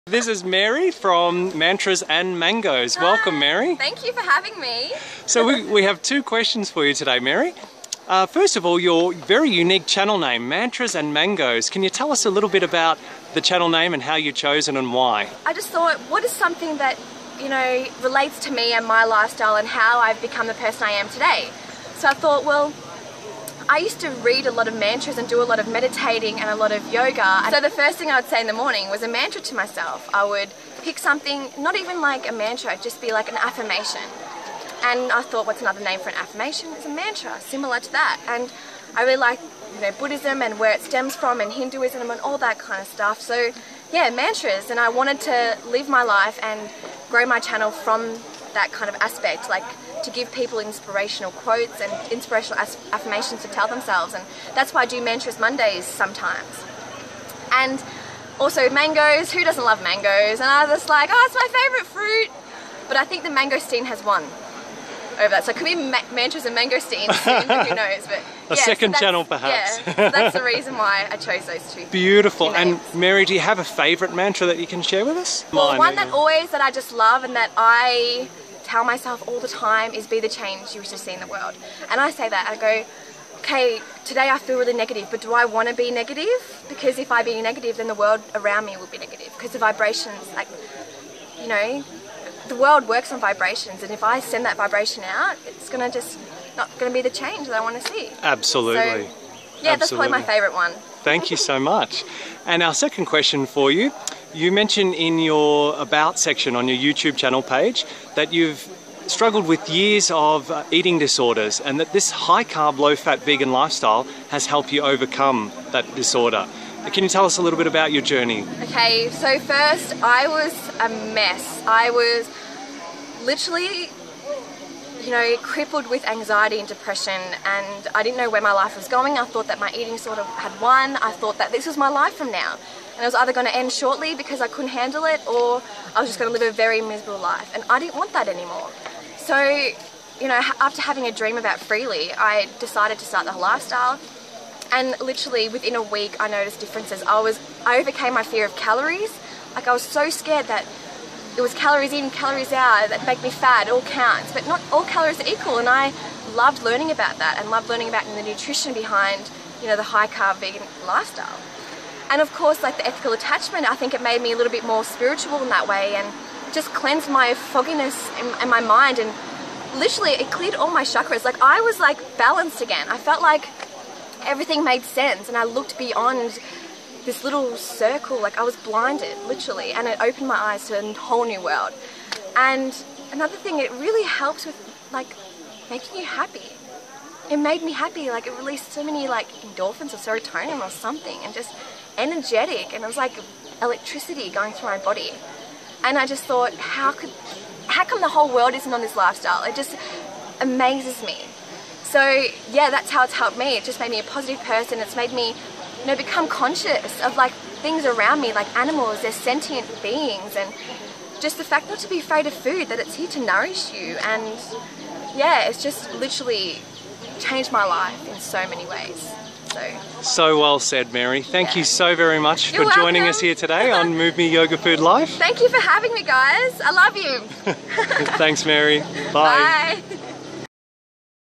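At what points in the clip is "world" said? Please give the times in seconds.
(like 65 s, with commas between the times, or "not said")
81 s, 87 s, 92 s, 181 s, 198 s.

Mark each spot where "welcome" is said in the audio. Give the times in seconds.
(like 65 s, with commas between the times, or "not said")
3 s, 222 s.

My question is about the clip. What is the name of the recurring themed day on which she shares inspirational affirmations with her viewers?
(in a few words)
Mantras Mondays.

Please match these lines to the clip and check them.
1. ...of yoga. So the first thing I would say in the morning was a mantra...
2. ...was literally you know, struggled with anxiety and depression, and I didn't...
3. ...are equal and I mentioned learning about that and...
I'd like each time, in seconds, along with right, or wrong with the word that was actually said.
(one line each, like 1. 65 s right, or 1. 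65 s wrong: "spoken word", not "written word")
1. 26 s right
2. 121 s wrong: "crippled", not "struggled"
3. 155 s wrong: "loved", not "mentioned".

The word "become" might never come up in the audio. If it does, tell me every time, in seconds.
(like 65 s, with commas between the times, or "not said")
20 s, 205 s.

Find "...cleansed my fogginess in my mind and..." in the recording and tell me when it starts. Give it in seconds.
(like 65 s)
166 s.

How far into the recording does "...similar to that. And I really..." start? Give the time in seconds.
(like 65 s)
37 s.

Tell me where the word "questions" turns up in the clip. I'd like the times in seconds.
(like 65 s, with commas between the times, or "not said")
6 s, 103 s.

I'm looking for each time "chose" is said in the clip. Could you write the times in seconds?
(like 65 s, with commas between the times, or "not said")
14 s, 71 s.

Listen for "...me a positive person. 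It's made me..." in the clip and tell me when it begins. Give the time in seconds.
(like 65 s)
203 s.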